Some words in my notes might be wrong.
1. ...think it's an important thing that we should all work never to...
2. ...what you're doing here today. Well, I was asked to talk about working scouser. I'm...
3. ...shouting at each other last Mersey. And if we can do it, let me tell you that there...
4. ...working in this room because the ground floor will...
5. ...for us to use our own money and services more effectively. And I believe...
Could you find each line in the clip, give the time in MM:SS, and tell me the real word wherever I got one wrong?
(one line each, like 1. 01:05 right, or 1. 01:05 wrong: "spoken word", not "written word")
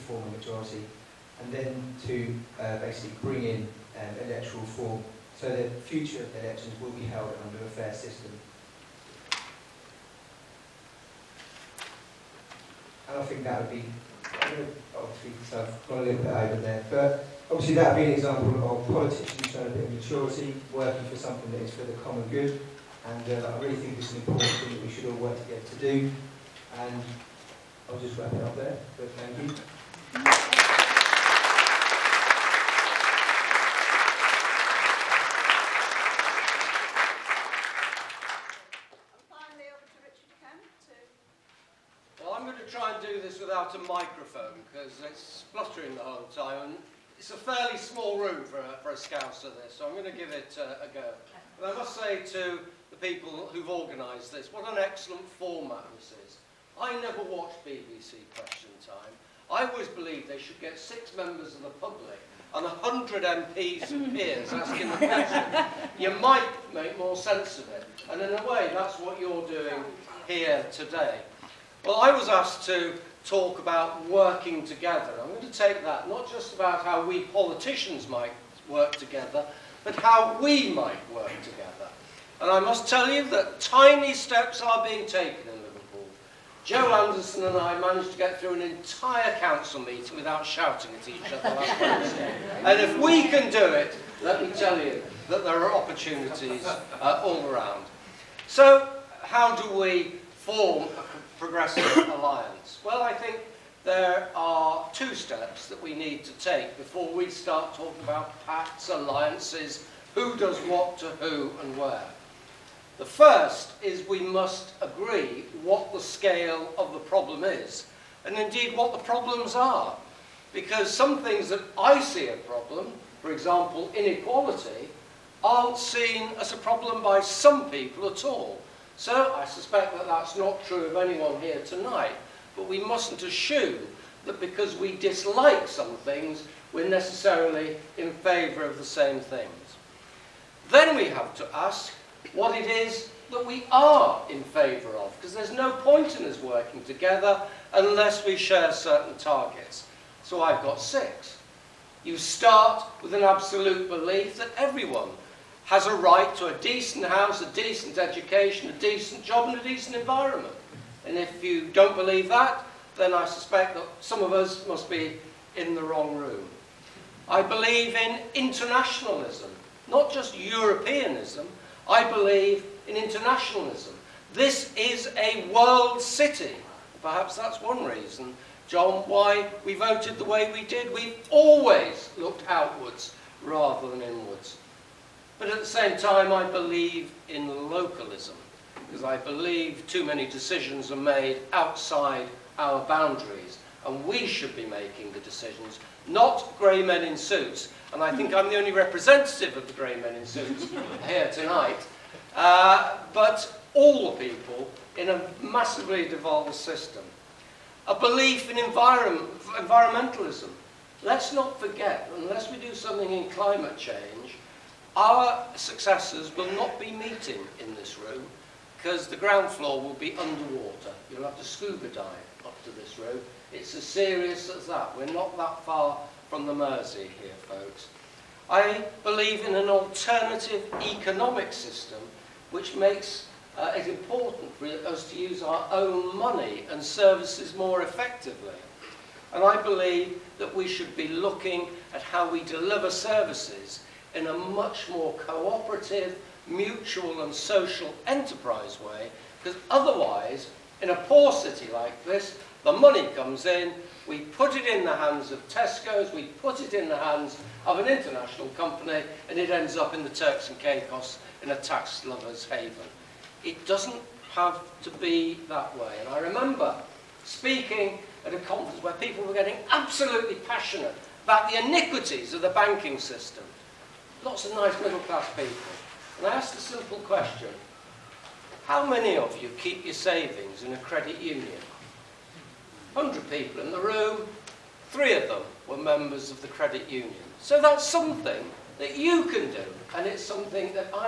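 1. 00:23 wrong: "together", not "never"
2. 01:08 wrong: "together", not "scouser"
3. 01:30 wrong: "Wednesday", not "Mersey"
4. 03:36 wrong: "meeting", not "working"
5. 03:54 right.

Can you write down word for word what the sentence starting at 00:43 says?
without a microphone because it's spluttering the whole time.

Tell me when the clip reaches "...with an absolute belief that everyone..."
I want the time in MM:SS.
02:33.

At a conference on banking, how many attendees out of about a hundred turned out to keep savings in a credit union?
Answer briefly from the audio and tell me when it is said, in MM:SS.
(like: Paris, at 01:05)
3, at 04:44.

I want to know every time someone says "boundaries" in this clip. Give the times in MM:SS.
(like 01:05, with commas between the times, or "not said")
03:12.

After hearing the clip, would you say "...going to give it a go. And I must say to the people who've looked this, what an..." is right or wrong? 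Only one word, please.
wrong.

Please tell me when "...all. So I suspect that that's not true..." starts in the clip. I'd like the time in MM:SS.
02:08.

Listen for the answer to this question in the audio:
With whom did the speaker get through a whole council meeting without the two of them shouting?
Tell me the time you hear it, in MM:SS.
01:26.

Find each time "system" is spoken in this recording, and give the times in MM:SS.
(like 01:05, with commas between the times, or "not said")
00:07, 03:26, 03:51, 04:32.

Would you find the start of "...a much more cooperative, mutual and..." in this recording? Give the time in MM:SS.
04:04.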